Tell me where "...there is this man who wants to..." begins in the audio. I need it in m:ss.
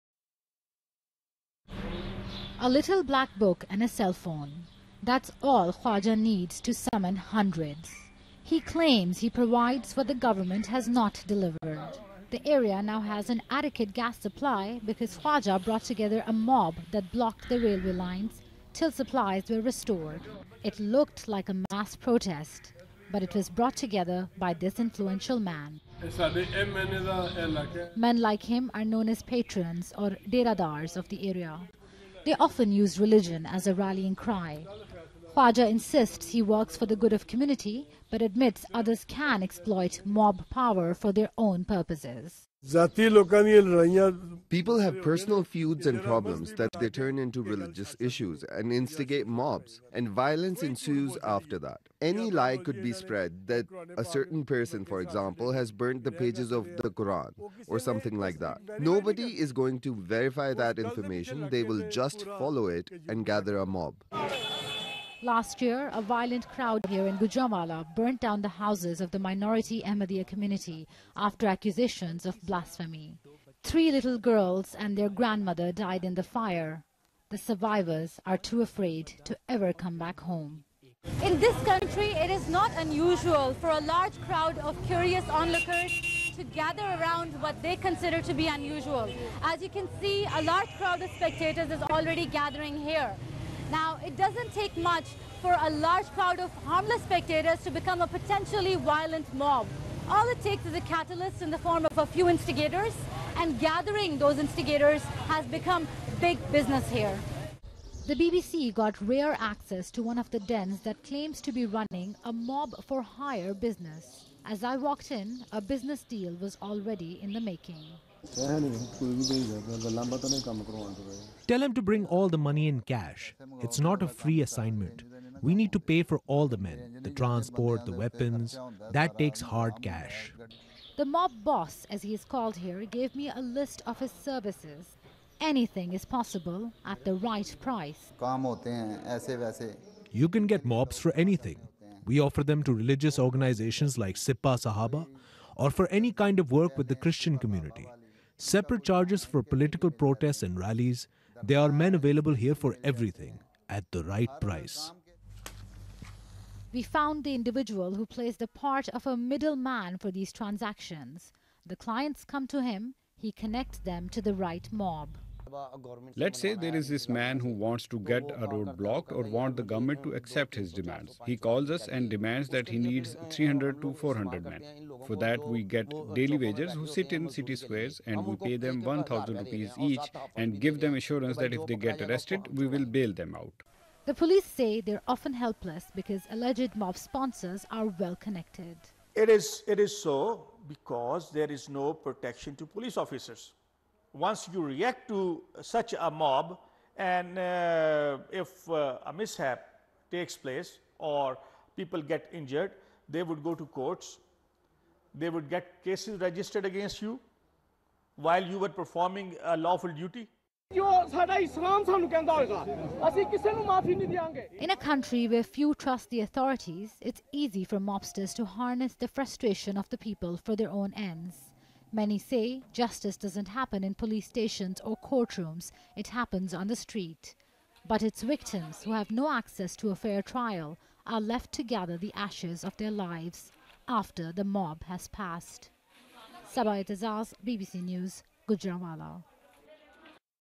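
2:46.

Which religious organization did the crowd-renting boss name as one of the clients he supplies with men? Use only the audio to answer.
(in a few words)
Sipah Sahaba.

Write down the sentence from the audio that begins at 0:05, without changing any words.
That's all Khwaja needs to summon hundreds.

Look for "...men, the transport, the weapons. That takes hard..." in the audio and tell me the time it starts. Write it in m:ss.
2:06.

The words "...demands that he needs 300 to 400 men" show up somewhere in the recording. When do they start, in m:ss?
2:52.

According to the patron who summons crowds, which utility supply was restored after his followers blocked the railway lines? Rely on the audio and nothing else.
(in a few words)
gas.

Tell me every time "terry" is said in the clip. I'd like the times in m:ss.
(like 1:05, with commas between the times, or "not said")
not said.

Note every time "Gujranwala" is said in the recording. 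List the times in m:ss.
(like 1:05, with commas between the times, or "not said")
1:07, 3:58.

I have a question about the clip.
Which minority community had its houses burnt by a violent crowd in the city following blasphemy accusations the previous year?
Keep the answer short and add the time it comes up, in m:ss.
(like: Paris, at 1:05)
Ahmadiyya, at 1:09.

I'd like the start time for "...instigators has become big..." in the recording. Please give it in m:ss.
1:44.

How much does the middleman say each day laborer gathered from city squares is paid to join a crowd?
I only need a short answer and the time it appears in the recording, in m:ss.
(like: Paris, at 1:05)
1,000 rupees, at 2:58.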